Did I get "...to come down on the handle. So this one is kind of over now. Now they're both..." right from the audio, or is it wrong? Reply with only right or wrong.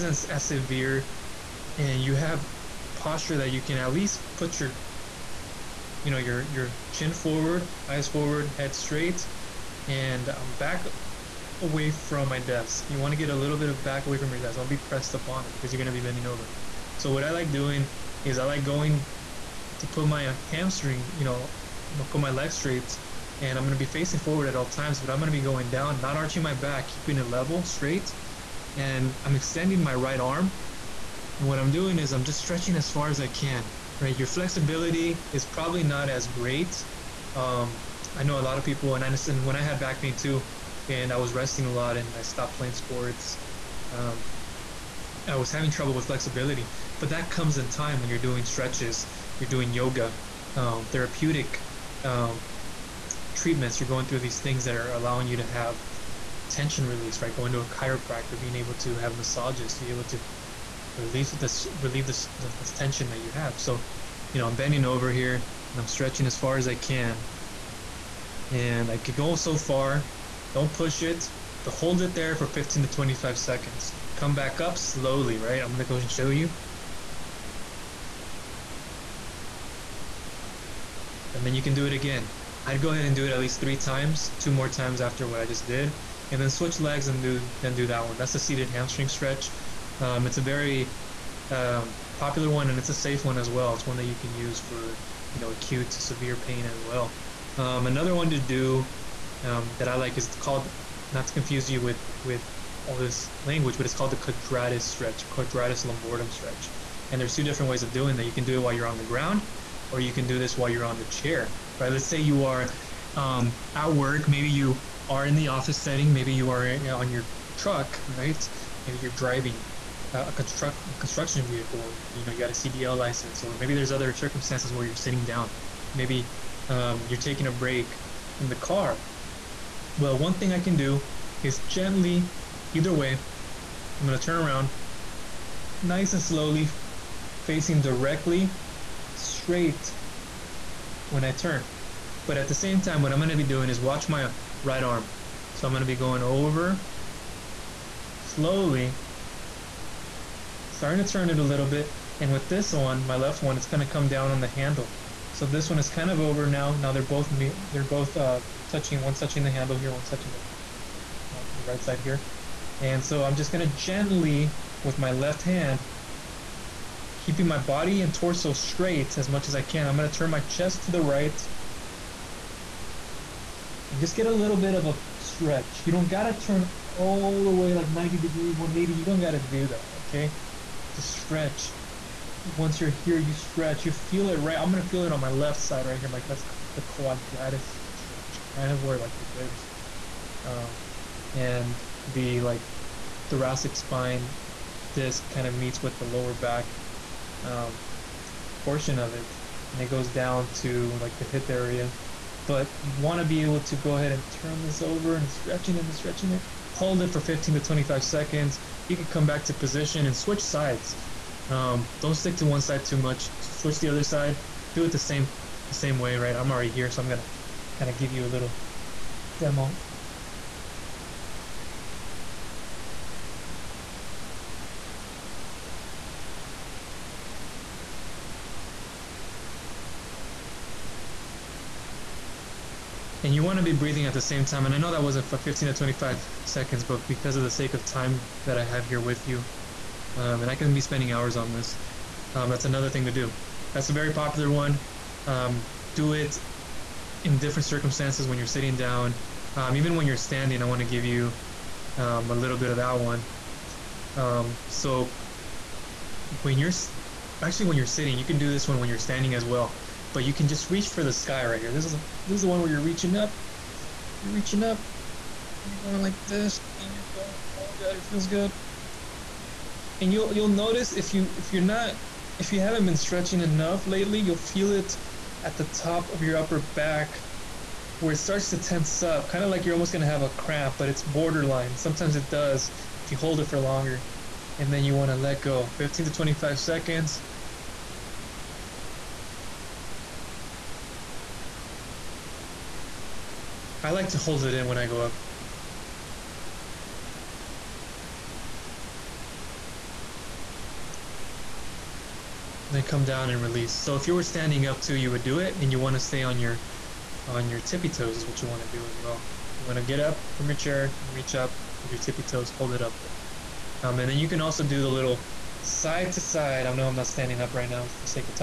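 right.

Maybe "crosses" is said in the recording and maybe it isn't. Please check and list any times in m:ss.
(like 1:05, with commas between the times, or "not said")
not said.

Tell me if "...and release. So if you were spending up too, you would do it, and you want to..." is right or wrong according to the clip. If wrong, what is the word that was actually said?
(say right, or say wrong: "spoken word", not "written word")
wrong: "standing", not "spending".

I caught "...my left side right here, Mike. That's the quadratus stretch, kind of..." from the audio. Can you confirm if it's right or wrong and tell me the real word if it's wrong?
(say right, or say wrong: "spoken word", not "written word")
right.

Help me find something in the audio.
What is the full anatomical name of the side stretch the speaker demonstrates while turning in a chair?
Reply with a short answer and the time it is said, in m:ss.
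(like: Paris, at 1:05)
quadratus lumborum stretch, at 1:45.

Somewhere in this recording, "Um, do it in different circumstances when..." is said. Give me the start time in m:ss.
4:05.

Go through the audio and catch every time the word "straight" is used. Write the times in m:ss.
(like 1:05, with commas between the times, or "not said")
0:08, 0:22, 0:27, 2:19, 2:48.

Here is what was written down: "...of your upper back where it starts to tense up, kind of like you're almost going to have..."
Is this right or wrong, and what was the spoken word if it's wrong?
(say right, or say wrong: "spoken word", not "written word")
right.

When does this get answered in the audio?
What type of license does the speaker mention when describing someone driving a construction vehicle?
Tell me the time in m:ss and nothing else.
2:02.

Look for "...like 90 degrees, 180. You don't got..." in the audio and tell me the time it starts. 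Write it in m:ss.
2:57.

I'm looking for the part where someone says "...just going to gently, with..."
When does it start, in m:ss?
2:43.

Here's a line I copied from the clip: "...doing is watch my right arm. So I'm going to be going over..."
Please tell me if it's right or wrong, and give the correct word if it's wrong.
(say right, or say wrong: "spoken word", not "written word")
right.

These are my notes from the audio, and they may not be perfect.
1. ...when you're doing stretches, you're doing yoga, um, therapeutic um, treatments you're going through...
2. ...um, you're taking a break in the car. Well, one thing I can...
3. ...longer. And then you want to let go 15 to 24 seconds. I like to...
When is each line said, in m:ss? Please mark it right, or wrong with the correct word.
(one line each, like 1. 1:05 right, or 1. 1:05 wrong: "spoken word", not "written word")
1. 0:47 right
2. 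2:06 right
3. 4:43 wrong: "25", not "24".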